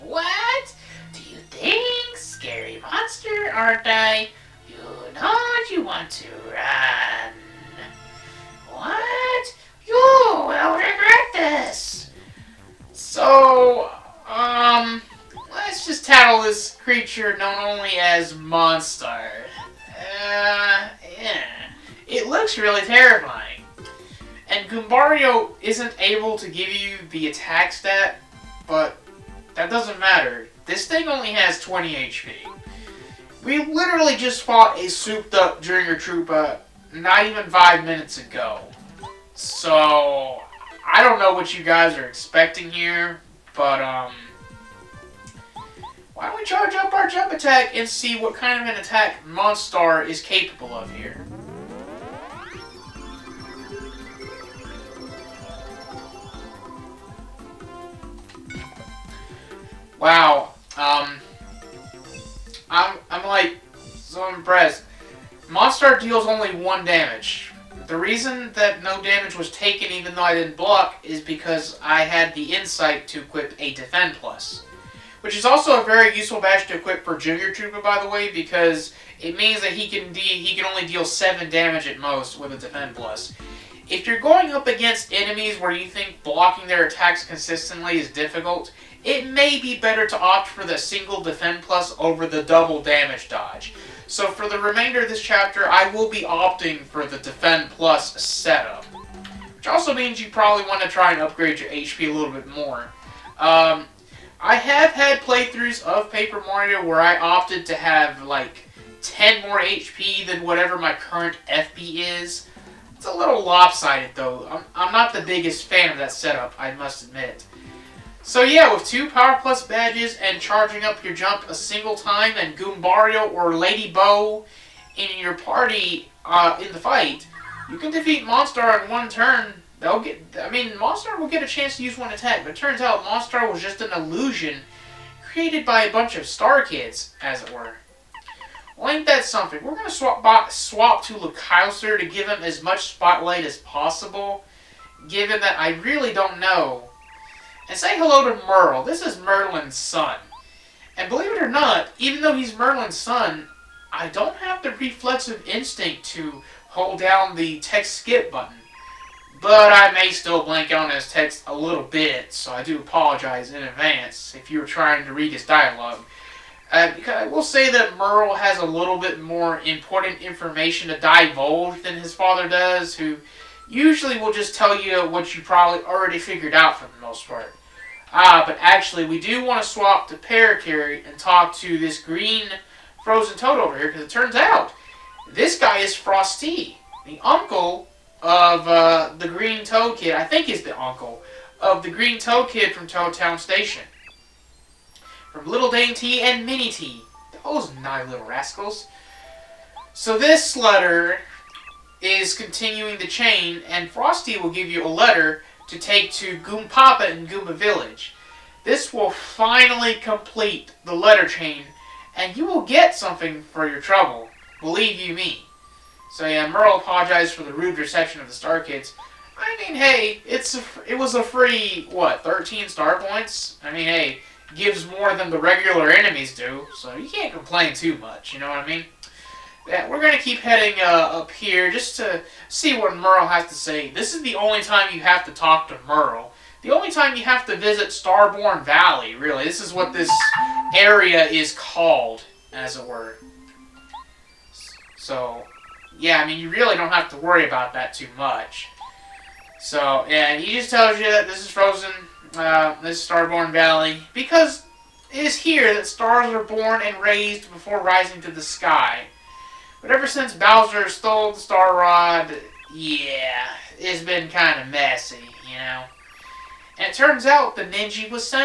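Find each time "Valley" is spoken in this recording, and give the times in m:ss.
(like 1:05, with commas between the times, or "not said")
3:58, 4:13.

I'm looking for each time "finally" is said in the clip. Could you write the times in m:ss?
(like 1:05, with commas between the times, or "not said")
3:29.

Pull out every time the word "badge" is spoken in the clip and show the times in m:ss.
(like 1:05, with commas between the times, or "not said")
1:16, 1:59.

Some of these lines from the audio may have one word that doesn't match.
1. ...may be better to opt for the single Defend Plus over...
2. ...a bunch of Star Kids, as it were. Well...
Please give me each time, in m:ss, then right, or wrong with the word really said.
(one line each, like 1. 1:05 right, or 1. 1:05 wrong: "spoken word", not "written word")
1. 1:29 right
2. 2:15 right.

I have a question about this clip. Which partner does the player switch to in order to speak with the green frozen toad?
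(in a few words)
Parakarry.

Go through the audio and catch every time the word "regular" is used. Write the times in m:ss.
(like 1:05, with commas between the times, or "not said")
3:45.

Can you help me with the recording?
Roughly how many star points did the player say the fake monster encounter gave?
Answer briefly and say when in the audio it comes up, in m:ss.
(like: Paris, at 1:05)
13, at 3:42.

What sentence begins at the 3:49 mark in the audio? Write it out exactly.
Yeah, we're going to keep heading uh, up here just to see what Merle has to say.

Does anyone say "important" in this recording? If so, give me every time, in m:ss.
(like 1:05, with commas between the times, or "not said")
2:49.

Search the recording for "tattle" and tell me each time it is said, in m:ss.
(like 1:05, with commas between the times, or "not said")
0:16.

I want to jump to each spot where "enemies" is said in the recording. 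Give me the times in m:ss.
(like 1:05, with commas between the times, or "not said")
1:25, 3:45.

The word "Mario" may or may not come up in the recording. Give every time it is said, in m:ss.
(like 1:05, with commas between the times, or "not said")
1:46.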